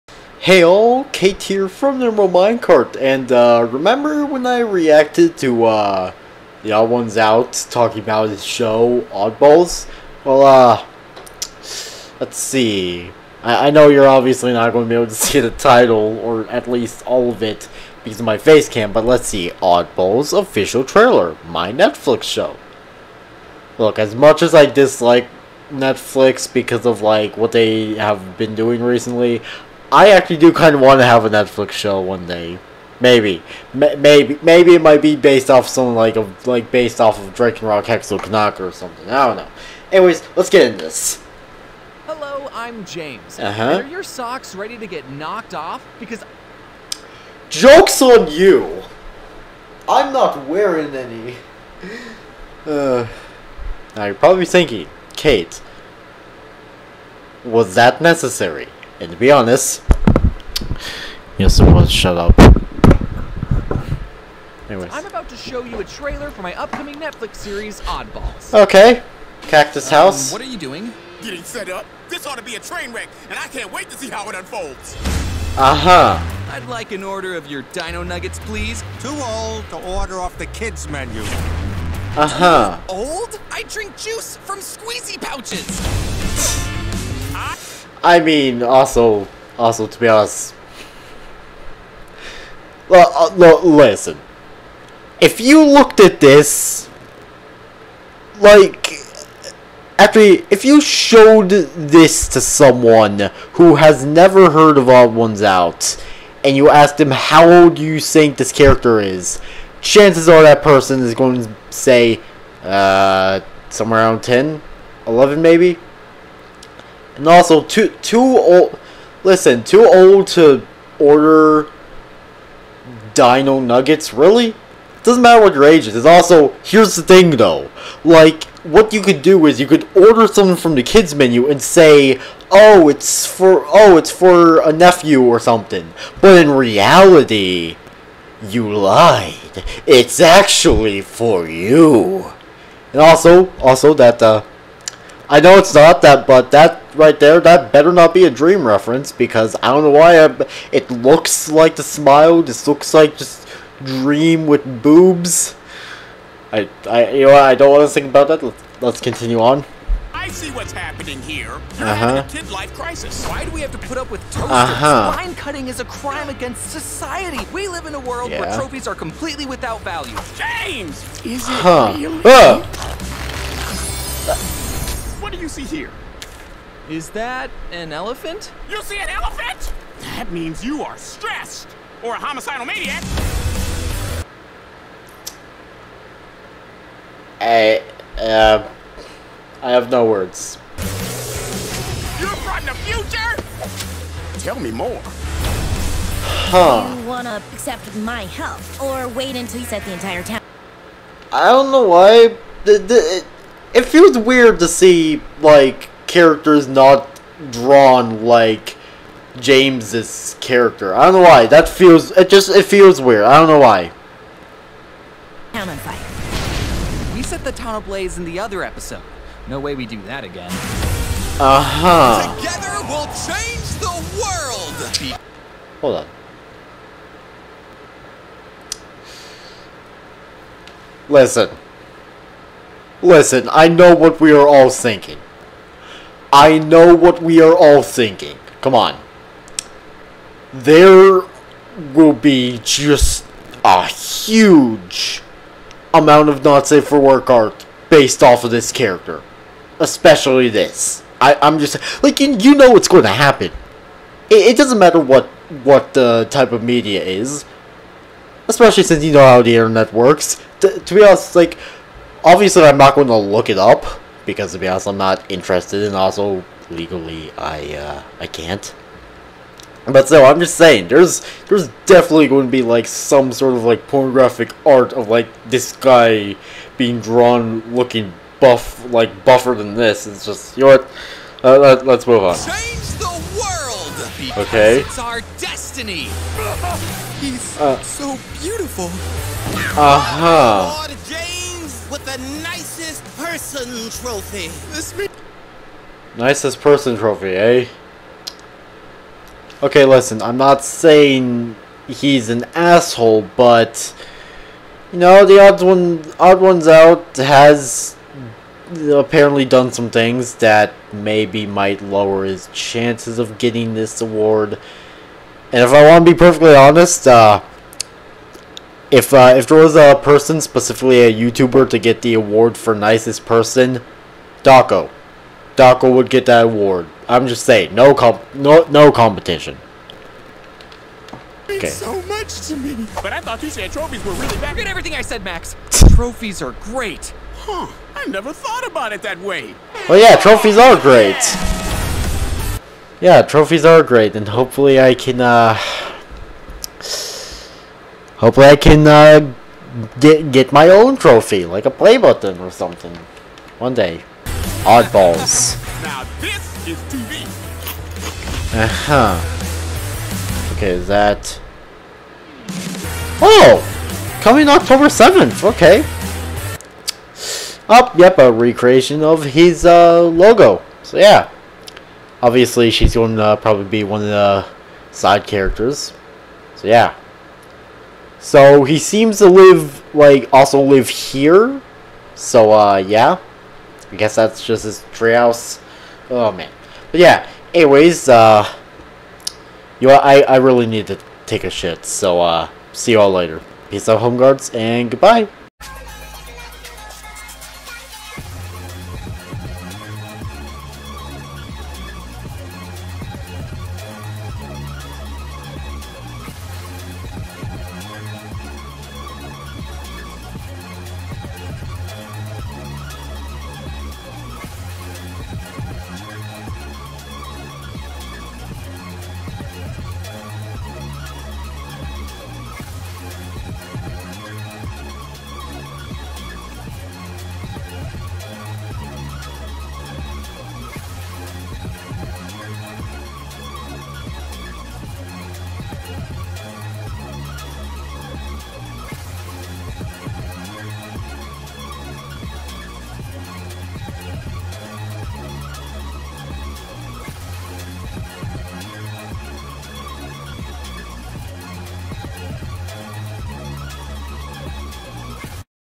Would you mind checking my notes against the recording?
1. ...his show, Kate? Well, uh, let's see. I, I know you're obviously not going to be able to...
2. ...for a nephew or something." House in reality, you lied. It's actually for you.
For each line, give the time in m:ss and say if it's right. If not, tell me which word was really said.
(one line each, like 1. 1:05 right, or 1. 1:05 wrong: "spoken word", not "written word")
1. 0:08 wrong: "Oddballs", not "Kate"
2. 2:14 wrong: "But", not "House".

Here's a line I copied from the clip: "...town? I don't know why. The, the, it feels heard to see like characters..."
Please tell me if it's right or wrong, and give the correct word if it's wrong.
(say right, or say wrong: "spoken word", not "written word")
wrong: "weird", not "heard".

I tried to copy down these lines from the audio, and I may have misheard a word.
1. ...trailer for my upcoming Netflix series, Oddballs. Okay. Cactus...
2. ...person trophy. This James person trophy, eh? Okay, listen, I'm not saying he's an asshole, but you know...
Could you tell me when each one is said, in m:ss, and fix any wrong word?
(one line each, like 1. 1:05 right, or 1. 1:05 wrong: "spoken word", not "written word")
1. 1:05 right
2. 4:53 wrong: "Nicest", not "James".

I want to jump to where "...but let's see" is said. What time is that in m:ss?
0:18.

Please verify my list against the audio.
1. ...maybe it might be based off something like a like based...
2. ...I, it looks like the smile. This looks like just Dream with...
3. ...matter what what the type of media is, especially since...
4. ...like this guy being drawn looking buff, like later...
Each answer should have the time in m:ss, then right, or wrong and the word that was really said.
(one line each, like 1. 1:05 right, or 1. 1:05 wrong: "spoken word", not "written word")
1. 0:34 right
2. 2:30 right
3. 4:14 right
4. 4:35 wrong: "buffer", not "later".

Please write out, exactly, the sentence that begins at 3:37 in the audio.
We set the town ablaze in the other episode.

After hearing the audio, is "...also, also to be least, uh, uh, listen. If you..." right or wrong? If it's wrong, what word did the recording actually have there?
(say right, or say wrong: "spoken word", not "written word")
wrong: "honest", not "least".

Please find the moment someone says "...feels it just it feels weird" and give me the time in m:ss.
3:31.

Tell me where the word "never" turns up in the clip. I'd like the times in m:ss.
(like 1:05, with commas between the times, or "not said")
1:44, 5:38.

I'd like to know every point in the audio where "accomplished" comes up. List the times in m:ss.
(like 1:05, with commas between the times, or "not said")
not said.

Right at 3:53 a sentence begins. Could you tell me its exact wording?
Listen, I know what we are all thinking.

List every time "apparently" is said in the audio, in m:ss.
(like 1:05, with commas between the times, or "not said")
5:08.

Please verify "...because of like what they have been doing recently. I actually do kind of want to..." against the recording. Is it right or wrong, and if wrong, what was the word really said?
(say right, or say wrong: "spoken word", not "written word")
right.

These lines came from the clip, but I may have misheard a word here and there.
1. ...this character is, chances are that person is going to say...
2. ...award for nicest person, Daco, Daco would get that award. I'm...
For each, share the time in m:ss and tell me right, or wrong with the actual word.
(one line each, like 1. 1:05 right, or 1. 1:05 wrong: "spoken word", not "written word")
1. 1:48 right
2. 5:22 right.